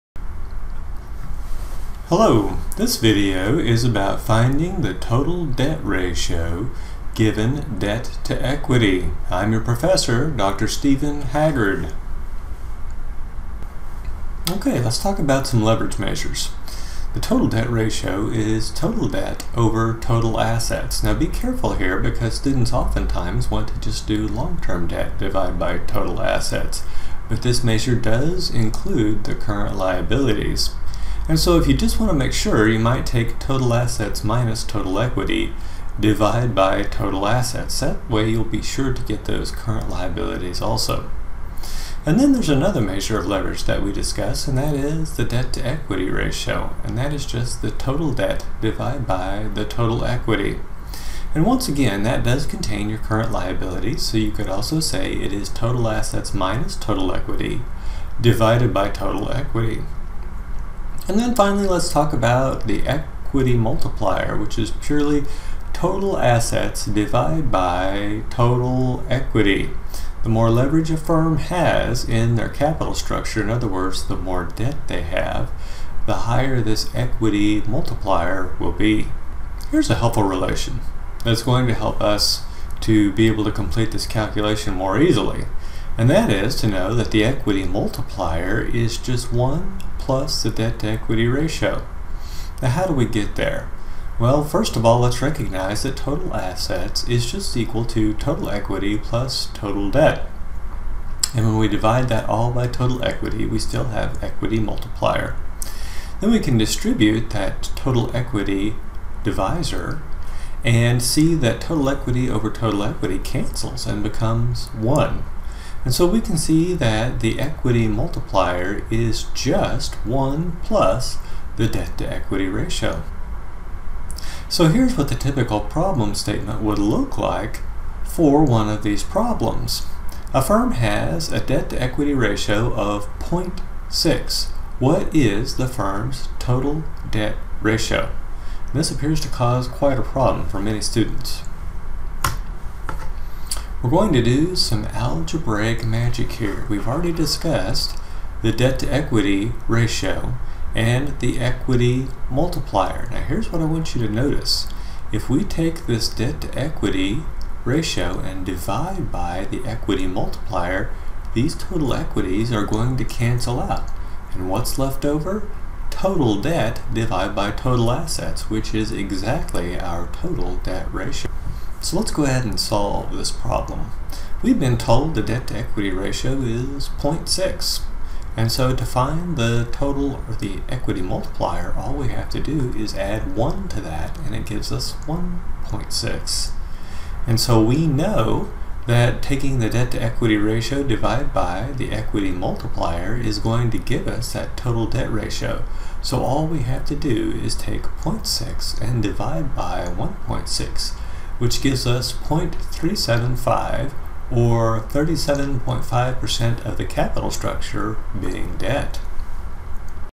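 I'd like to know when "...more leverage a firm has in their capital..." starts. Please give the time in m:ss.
1:10.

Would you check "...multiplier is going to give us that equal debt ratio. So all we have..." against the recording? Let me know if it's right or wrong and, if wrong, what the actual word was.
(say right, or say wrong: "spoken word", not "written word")
wrong: "total", not "equal".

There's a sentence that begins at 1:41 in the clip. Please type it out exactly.
And when we divide that all by total equity, we still have equity multiplier.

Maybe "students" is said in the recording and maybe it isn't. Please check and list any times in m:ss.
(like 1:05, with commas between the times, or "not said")
0:22, 2:20.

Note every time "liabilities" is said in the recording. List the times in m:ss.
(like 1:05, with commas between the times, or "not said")
0:29, 0:39, 0:53.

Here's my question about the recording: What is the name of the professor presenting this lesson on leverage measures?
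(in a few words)
Dr. Stephen Haggard.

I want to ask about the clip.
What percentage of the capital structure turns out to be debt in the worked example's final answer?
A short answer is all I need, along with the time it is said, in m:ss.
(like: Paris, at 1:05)
37.5%, at 3:24.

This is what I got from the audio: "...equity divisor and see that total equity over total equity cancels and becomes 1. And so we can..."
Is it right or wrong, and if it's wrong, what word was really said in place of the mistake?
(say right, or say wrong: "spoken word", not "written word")
right.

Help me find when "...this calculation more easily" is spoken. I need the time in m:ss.
1:23.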